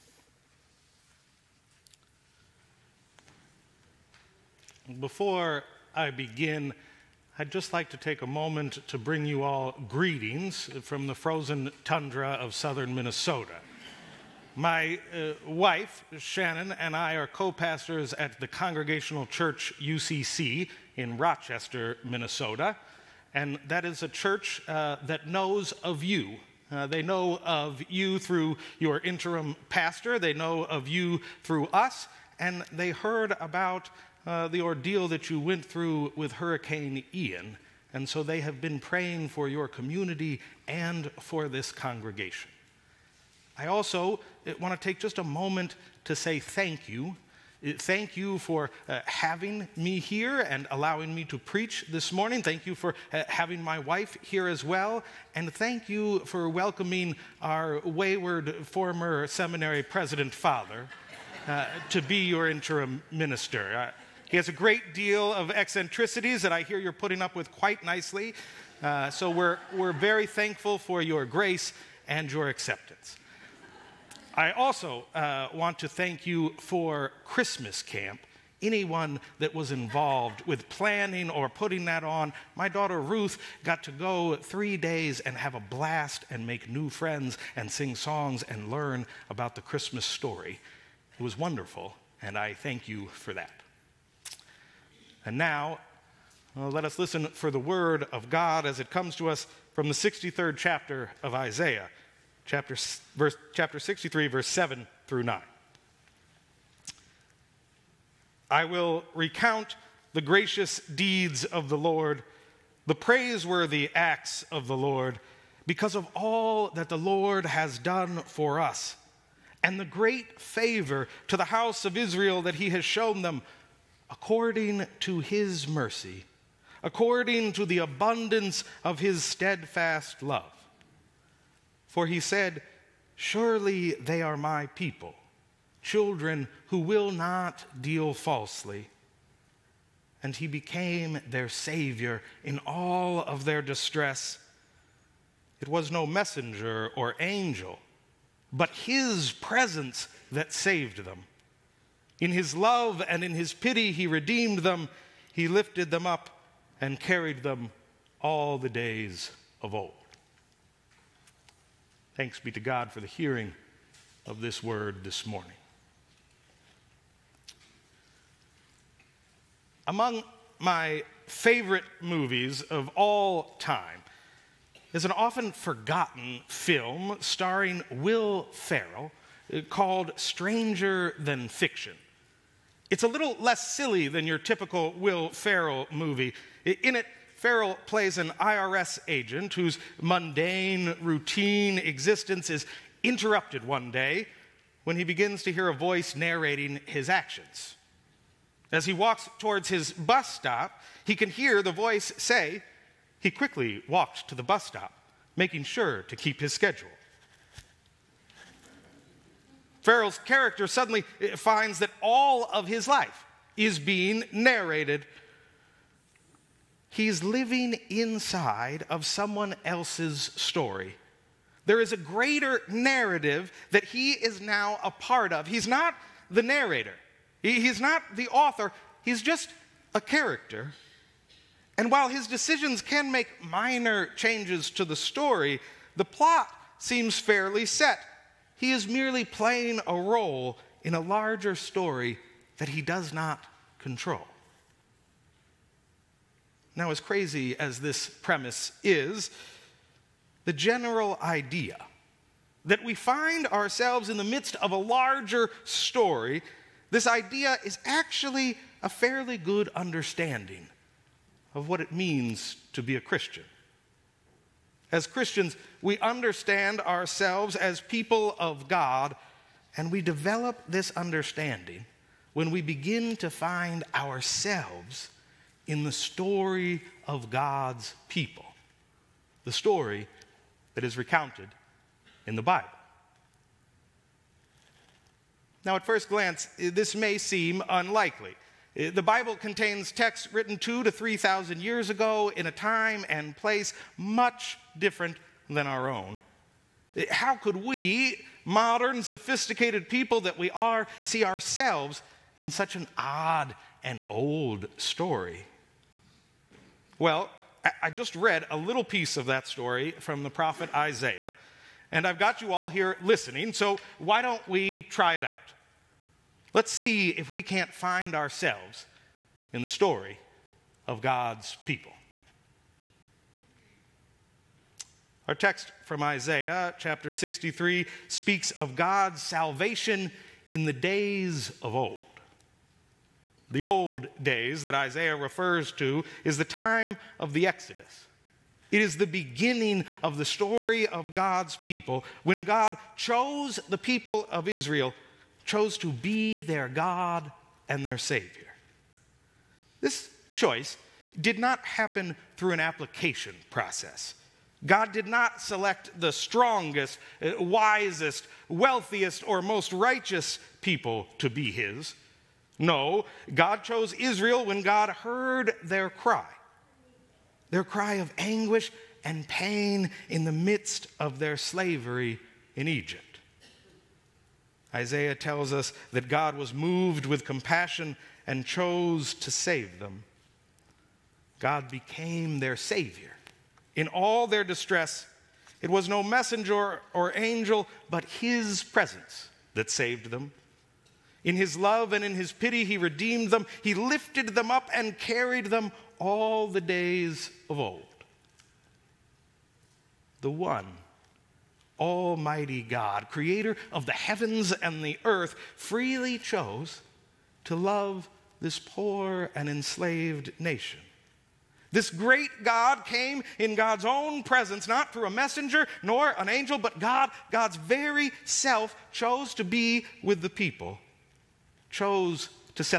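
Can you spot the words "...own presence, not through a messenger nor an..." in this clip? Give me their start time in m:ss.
6:53.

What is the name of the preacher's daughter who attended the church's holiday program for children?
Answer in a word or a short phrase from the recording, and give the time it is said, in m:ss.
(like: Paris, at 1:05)
Ruth, at 1:22.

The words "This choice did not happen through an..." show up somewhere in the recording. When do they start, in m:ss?
5:49.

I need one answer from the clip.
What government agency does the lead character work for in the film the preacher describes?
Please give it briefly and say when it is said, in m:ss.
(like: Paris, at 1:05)
IRS, at 3:08.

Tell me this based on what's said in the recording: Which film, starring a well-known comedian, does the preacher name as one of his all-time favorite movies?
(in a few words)
Stranger Than Fiction.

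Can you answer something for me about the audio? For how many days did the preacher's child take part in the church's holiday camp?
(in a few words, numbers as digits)
3.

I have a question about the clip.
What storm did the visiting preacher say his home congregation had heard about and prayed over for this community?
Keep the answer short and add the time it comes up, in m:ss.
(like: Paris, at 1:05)
Hurricane Ian, at 0:36.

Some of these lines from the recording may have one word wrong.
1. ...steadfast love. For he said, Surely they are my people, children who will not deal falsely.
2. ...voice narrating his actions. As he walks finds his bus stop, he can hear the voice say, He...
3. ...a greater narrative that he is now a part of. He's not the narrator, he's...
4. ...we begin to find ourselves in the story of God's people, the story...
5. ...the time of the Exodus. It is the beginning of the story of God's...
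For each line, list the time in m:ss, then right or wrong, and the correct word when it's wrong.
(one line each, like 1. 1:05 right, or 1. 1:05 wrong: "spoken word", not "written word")
1. 2:09 right
2. 3:15 wrong: "towards", not "finds"
3. 3:41 right
4. 4:32 right
5. 5:36 right.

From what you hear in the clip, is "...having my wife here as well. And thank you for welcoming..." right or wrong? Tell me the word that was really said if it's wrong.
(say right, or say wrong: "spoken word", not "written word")
right.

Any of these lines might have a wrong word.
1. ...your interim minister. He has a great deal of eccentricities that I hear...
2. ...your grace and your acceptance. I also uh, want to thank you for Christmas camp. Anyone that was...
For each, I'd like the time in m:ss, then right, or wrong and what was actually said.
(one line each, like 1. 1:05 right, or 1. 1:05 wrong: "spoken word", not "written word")
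1. 1:02 right
2. 1:11 right.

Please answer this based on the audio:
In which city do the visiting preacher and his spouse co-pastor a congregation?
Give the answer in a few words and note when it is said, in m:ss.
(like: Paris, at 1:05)
Rochester, Minnesota, at 0:21.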